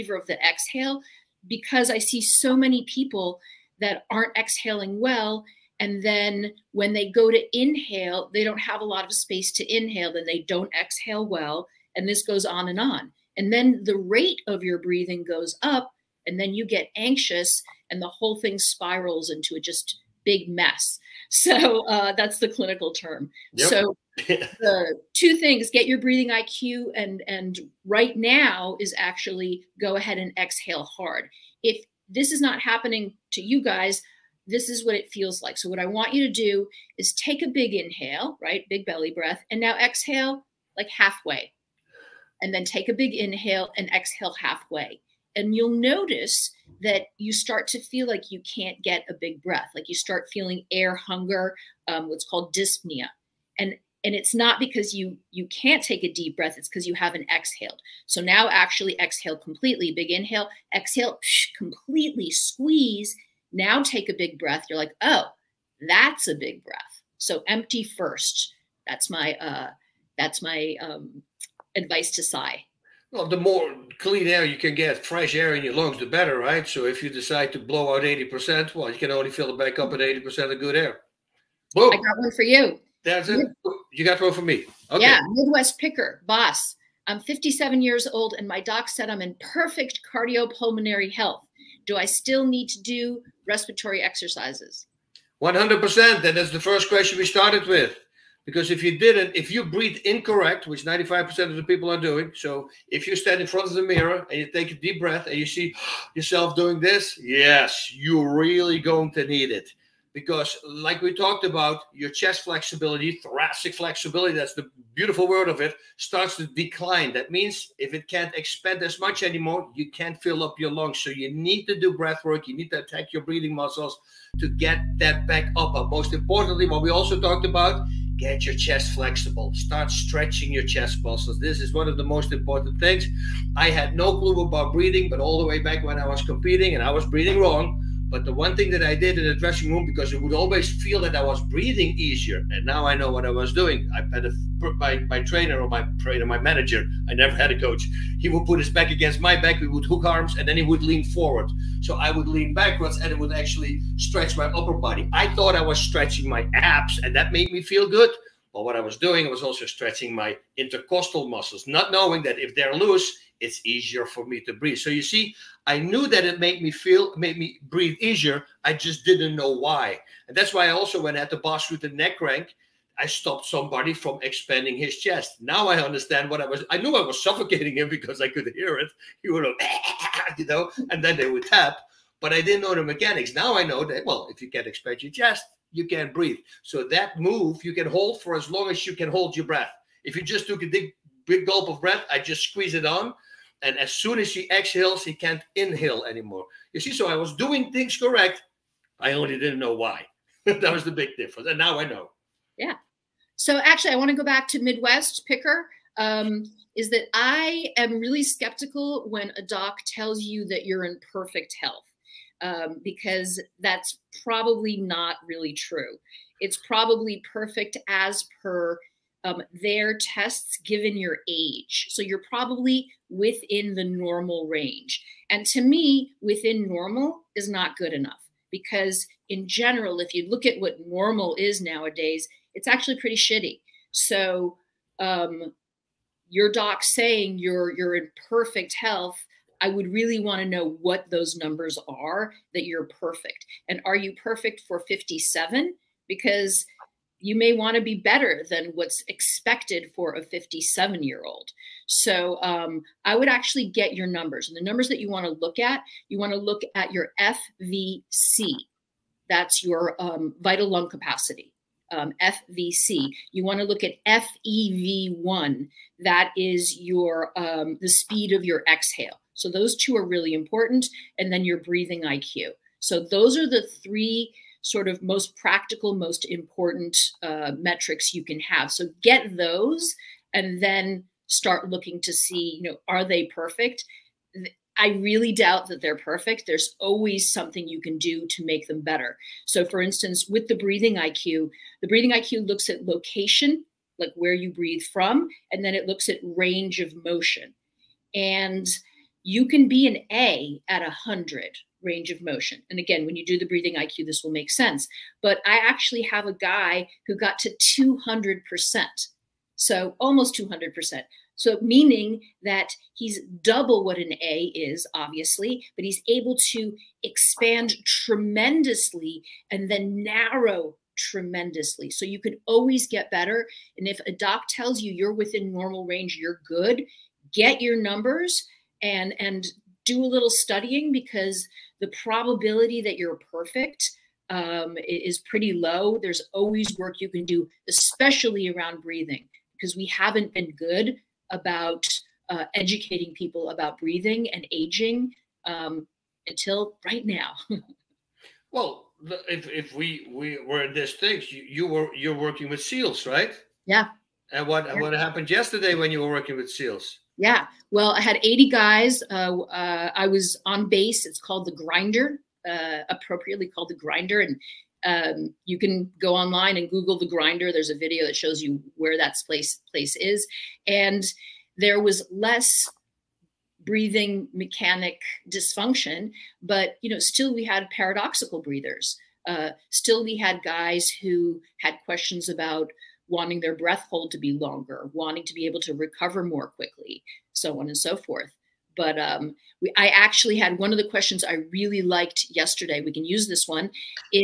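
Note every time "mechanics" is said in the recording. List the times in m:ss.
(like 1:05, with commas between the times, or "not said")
3:02, 6:14.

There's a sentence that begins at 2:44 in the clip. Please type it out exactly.
So you see, I knew that it made me feel, made me breathe easier.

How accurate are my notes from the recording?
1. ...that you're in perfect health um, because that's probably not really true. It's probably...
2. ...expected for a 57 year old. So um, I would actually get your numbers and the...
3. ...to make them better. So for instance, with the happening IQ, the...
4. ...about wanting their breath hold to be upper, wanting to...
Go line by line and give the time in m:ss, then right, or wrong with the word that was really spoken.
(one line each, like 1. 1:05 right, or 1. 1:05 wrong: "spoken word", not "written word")
1. 3:30 right
2. 4:09 right
3. 4:48 wrong: "breathing", not "happening"
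4. 6:22 wrong: "longer", not "upper".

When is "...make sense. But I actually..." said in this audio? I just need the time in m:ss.
5:04.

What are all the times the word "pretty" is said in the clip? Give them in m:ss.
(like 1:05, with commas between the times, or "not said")
3:52, 5:35.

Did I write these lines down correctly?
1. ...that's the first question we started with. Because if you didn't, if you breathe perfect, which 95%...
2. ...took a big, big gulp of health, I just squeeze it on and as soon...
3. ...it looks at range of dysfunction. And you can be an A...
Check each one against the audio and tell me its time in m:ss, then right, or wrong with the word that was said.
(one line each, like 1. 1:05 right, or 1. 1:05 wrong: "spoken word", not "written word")
1. 1:36 wrong: "incorrect", not "perfect"
2. 3:10 wrong: "breath", not "health"
3. 4:55 wrong: "motion", not "dysfunction".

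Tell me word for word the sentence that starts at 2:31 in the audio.
So I would lean backwards and it would actually stretch my upper body.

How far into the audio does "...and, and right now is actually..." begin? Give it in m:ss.
0:26.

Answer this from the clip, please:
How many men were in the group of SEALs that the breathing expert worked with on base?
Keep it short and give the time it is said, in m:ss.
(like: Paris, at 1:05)
80, at 5:58.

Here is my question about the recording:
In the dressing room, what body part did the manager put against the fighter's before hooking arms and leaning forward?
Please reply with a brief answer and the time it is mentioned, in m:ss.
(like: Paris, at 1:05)
his back, at 2:28.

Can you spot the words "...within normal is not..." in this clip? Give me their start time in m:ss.
3:46.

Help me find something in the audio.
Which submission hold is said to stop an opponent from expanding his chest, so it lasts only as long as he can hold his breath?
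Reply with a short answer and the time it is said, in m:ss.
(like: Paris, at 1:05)
neck crank, at 2:51.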